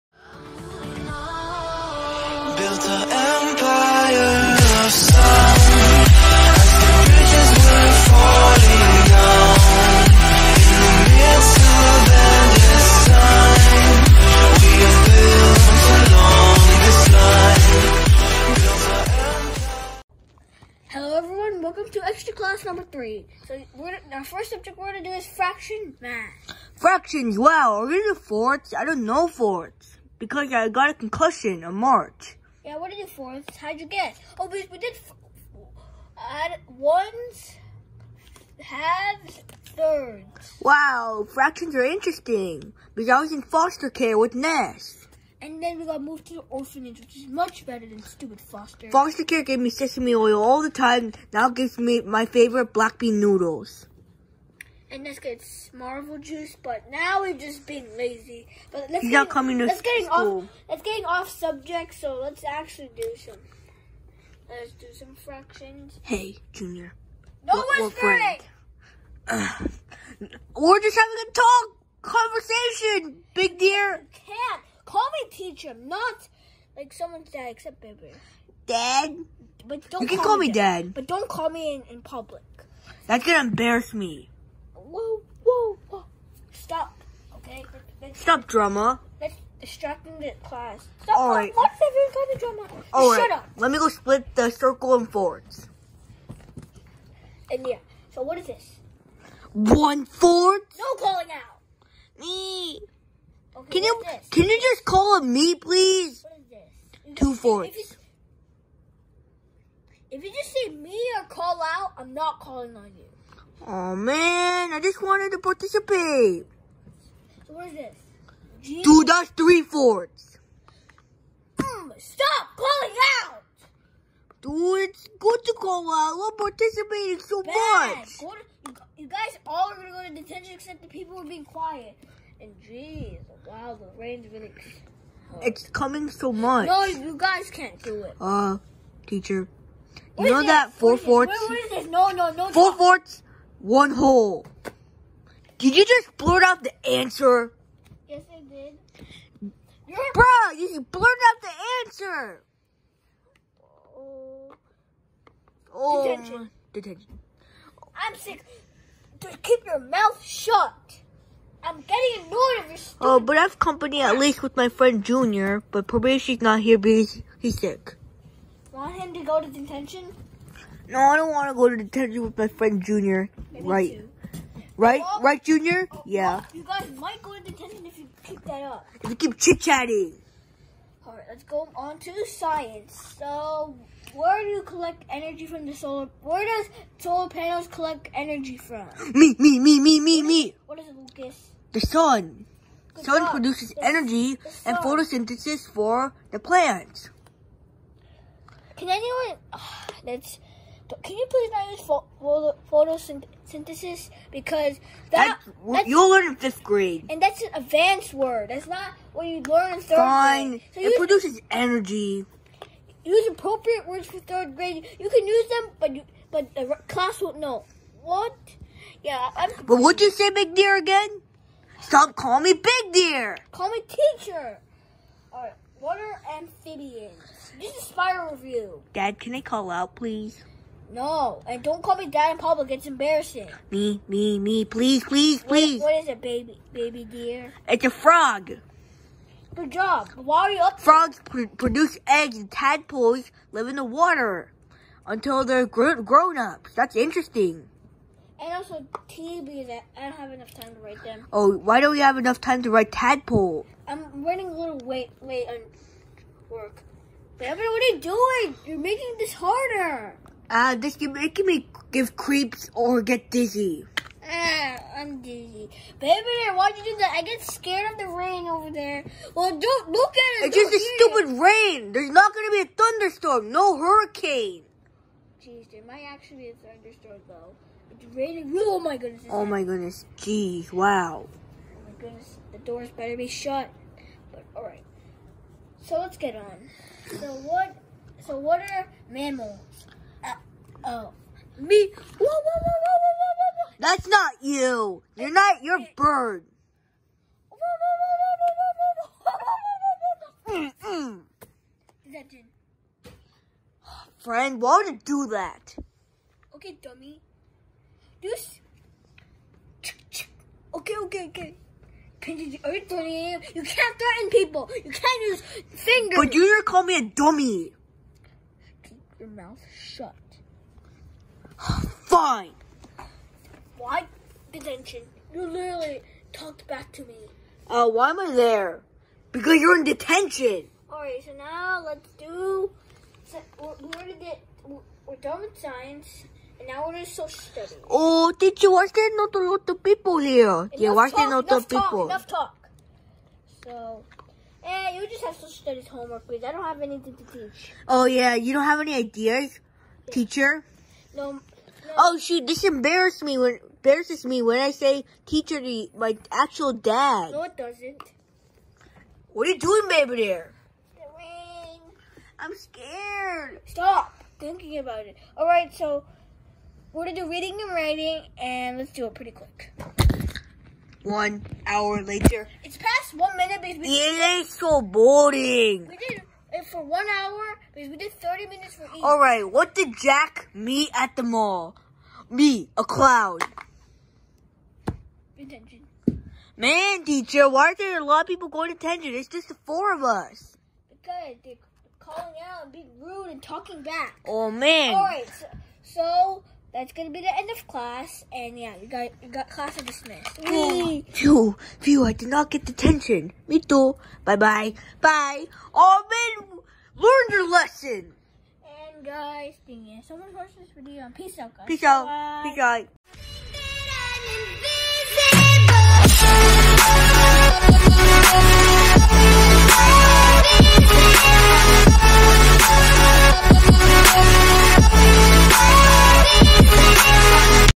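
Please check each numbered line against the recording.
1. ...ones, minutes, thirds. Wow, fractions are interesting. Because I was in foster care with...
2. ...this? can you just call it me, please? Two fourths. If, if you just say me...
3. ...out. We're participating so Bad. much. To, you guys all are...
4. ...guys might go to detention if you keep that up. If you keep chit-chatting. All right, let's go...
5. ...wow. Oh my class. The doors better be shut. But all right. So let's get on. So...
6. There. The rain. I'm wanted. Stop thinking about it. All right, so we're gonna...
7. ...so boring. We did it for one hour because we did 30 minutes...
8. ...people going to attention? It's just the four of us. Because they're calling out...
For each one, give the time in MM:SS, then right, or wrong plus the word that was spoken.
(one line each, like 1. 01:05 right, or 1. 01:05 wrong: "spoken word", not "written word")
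1. 00:36 wrong: "halves", not "minutes"
2. 01:44 right
3. 02:05 right
4. 02:56 right
5. 04:40 wrong: "goodness", not "class"
6. 06:00 wrong: "scared", not "wanted"
7. 06:14 right
8. 06:28 right.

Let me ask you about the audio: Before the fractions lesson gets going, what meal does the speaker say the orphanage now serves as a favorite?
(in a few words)
black bean noodles.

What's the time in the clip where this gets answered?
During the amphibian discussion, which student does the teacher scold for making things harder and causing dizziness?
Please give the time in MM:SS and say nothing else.
04:17.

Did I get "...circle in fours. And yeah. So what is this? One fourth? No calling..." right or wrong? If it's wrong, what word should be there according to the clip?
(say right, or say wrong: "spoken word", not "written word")
right.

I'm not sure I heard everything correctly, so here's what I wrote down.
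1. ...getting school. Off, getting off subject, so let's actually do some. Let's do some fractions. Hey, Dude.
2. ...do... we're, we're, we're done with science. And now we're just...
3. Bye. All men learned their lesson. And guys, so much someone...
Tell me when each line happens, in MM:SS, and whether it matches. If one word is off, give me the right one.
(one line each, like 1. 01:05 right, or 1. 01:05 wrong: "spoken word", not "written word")
1. 00:59 wrong: "Junior", not "Dude"
2. 05:32 right
3. 06:45 right.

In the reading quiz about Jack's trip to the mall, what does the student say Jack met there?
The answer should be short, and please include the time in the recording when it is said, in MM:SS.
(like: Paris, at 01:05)
a cloud, at 06:22.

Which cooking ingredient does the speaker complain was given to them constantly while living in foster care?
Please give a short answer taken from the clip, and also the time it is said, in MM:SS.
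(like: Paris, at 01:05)
sesame oil, at 00:49.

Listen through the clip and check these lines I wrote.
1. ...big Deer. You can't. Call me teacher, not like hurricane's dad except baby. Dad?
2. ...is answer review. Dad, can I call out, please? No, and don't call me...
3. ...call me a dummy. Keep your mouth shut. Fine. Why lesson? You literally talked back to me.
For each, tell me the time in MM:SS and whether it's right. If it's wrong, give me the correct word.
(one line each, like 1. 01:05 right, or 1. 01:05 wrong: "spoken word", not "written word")
1. 01:13 wrong: "someone", not "hurricane"
2. 03:47 wrong: "spider", not "answer"
3. 05:16 wrong: "detention", not "lesson".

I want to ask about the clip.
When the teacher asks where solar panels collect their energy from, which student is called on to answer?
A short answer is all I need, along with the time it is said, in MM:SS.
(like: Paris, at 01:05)
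Lucas, at 03:10.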